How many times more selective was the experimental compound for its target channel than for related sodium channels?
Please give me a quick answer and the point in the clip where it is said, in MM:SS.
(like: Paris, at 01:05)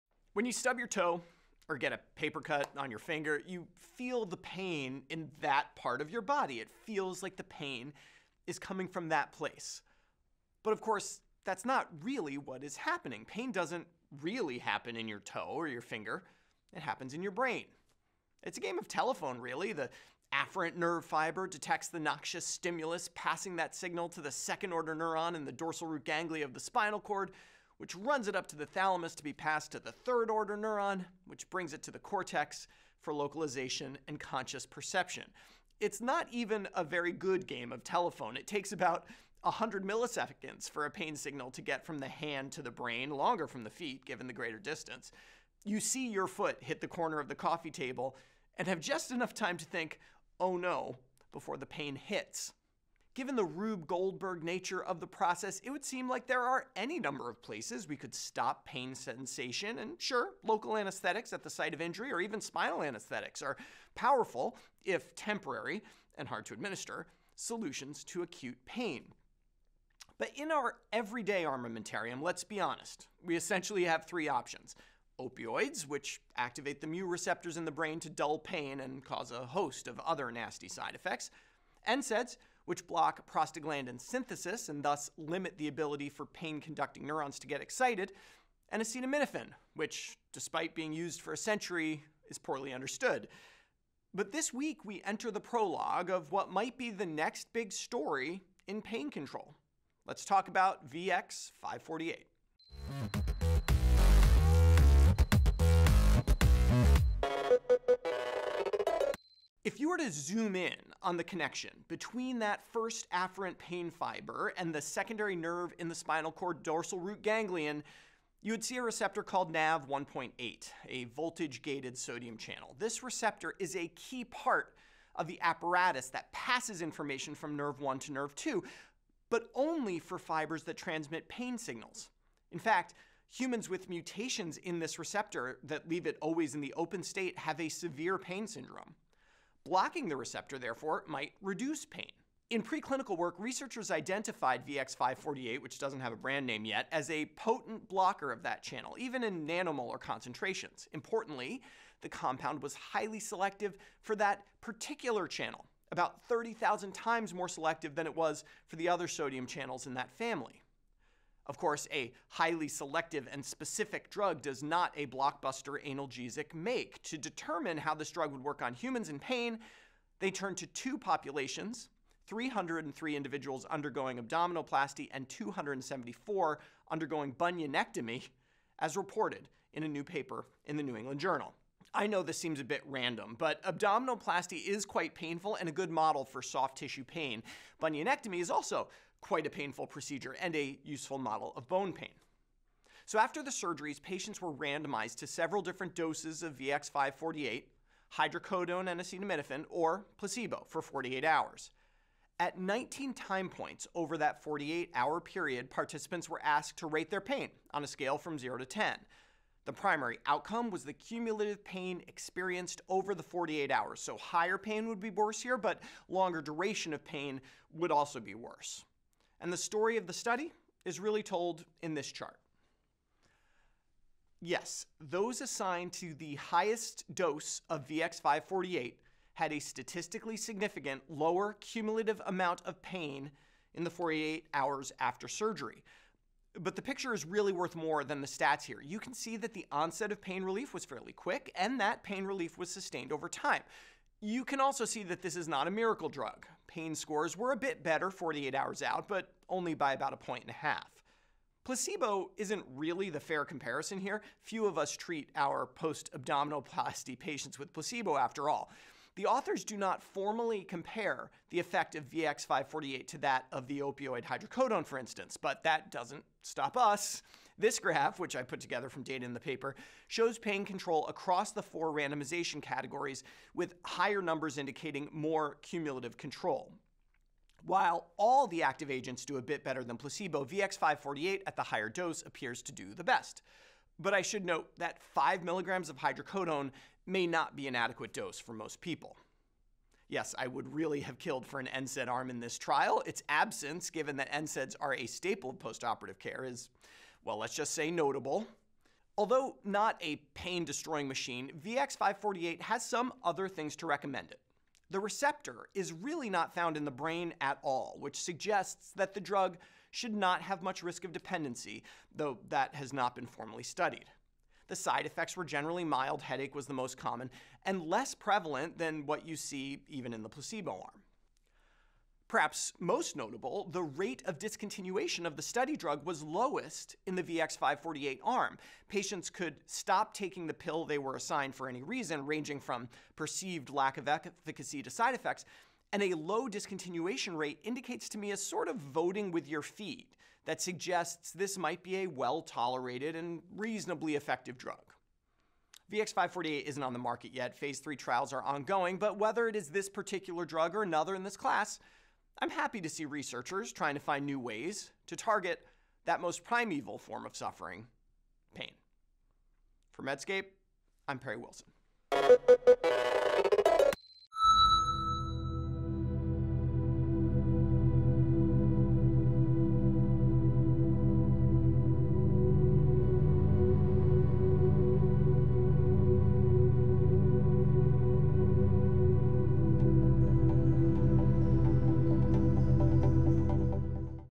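30,000, at 02:36.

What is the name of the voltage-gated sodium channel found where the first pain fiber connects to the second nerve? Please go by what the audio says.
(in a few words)
NAV1.8.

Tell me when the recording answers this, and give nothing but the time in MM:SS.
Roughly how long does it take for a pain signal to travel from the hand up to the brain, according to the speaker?
00:39.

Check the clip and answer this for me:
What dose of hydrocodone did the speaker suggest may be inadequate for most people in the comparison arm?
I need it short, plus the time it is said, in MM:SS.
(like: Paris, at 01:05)
5 milligrams, at 04:45.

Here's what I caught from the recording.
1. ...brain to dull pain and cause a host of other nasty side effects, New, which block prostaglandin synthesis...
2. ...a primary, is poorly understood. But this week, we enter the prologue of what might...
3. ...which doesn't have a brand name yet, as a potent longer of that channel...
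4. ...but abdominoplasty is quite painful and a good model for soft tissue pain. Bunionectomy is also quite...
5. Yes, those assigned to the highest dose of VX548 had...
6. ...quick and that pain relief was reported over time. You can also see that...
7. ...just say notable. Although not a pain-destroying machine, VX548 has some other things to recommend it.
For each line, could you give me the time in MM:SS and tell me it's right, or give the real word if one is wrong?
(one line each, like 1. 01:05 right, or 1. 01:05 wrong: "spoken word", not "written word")
1. 01:17 wrong: "NSAIDs", not "New"
2. 01:31 wrong: "century", not "primary"
3. 02:25 wrong: "blocker", not "longer"
4. 03:03 right
5. 03:44 right
6. 04:01 wrong: "sustained", not "reported"
7. 04:57 right.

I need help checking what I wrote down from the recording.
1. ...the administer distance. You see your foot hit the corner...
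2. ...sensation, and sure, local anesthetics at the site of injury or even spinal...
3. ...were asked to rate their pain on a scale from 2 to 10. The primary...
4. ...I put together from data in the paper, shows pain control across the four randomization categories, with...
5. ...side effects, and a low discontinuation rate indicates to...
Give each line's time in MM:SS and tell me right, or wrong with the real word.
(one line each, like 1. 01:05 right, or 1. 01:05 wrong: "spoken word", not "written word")
1. 00:44 wrong: "greater", not "administer"
2. 00:58 right
3. 03:26 wrong: "0", not "2"
4. 04:28 right
5. 05:34 right.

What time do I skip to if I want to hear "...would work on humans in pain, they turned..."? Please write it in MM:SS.
02:48.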